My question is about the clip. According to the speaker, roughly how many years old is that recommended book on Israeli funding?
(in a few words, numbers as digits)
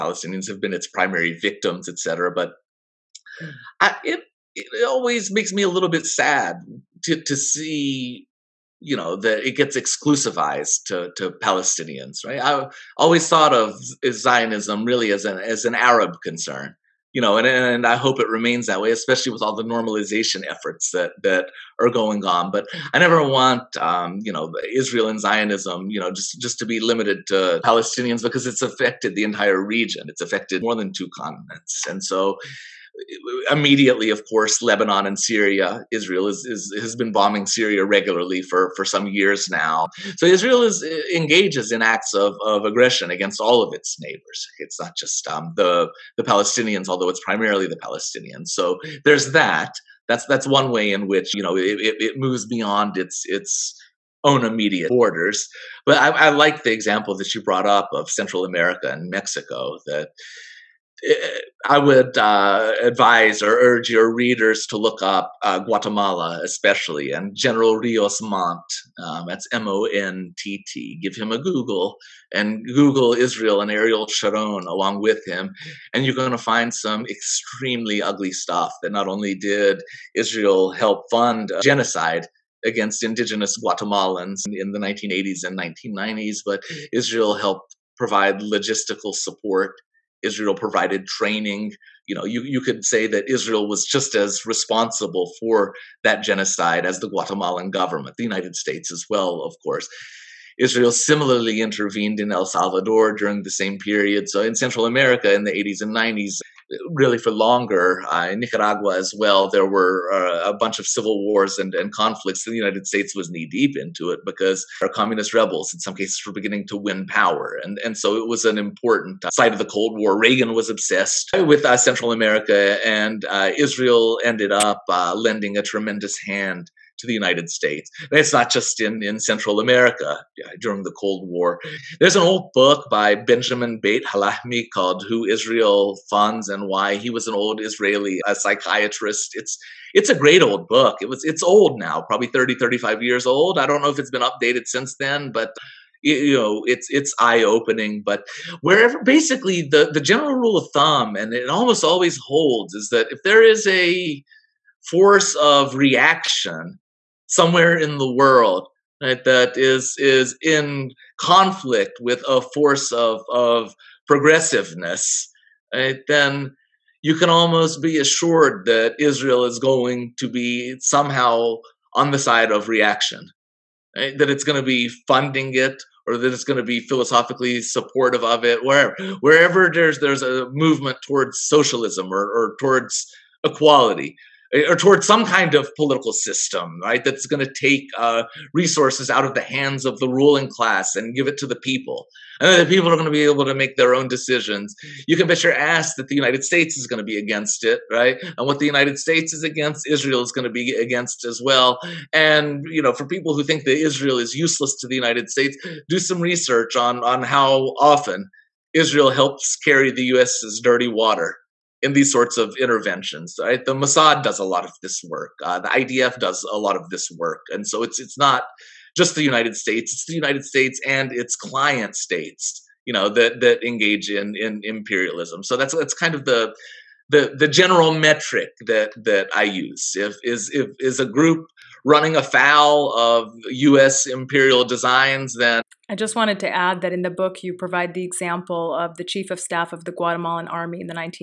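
30 to 35 years.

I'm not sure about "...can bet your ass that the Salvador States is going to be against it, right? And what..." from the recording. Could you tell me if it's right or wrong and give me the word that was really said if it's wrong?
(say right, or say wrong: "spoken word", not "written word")
wrong: "United", not "Salvador".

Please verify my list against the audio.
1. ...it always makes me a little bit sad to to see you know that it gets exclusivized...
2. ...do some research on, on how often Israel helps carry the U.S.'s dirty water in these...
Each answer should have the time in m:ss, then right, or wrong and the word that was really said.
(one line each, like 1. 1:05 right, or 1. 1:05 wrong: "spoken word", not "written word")
1. 0:04 right
2. 3:25 right.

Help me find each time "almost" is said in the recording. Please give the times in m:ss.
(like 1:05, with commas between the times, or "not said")
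2:31, 2:47.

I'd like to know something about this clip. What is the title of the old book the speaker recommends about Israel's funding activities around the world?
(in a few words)
Who Israel Funds and Why.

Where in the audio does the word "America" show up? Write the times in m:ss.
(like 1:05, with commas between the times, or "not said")
0:58, 1:44, 2:02, 2:09.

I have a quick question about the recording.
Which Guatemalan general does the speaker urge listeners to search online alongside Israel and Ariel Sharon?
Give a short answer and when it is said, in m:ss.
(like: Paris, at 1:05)
Rios Montt, at 1:07.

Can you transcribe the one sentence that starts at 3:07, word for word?
That's going to take uh, resources out of the hands of the ruling class and give it to the people.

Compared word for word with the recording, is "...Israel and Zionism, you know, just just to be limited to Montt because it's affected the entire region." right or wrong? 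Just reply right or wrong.
wrong.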